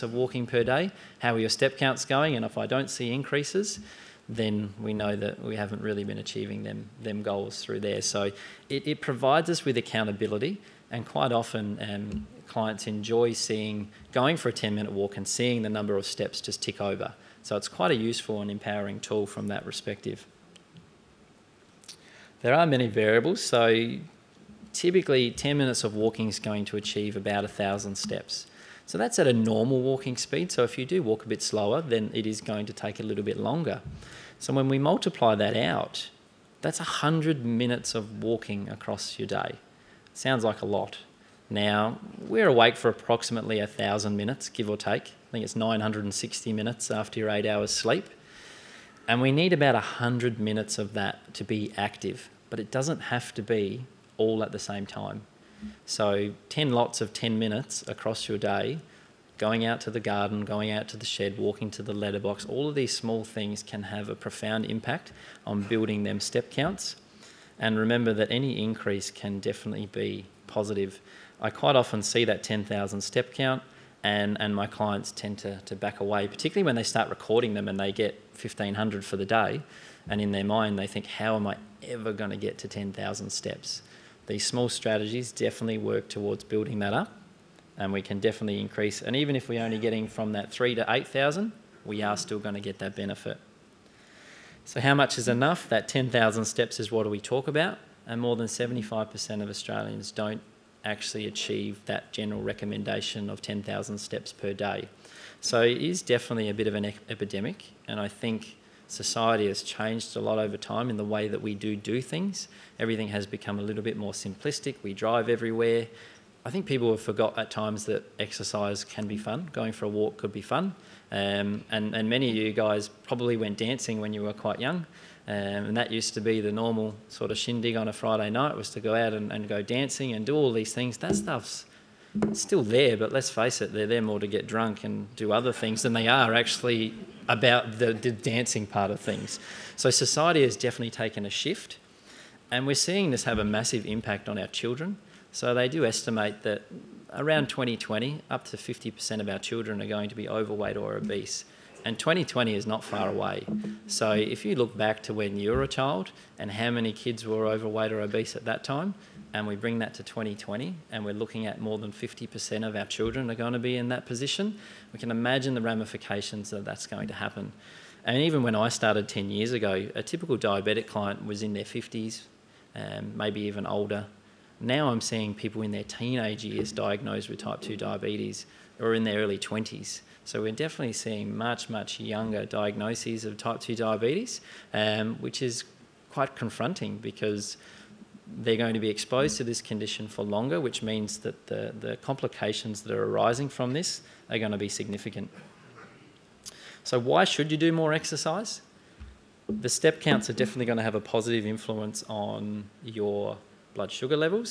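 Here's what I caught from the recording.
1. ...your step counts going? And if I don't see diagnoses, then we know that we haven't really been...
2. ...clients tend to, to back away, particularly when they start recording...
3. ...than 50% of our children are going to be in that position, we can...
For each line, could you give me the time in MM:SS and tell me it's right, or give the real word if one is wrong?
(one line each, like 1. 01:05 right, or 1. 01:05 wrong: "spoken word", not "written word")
1. 00:01 wrong: "increases", not "diagnoses"
2. 01:14 right
3. 02:41 right.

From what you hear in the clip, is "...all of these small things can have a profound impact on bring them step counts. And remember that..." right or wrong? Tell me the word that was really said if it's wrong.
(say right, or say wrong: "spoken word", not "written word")
wrong: "building", not "bring".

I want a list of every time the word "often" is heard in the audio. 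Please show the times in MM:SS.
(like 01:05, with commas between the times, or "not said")
00:11, 01:11.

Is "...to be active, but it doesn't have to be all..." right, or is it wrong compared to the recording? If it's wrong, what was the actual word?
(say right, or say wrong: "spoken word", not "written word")
right.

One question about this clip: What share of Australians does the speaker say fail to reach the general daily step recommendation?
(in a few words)
More than 75%.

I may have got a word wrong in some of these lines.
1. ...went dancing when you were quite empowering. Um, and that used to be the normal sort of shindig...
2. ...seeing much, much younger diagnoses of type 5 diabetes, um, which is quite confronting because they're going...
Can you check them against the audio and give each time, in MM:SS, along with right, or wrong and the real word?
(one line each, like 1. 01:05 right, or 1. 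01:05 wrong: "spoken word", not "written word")
1. 02:03 wrong: "young", not "empowering"
2. 03:00 wrong: "2", not "5".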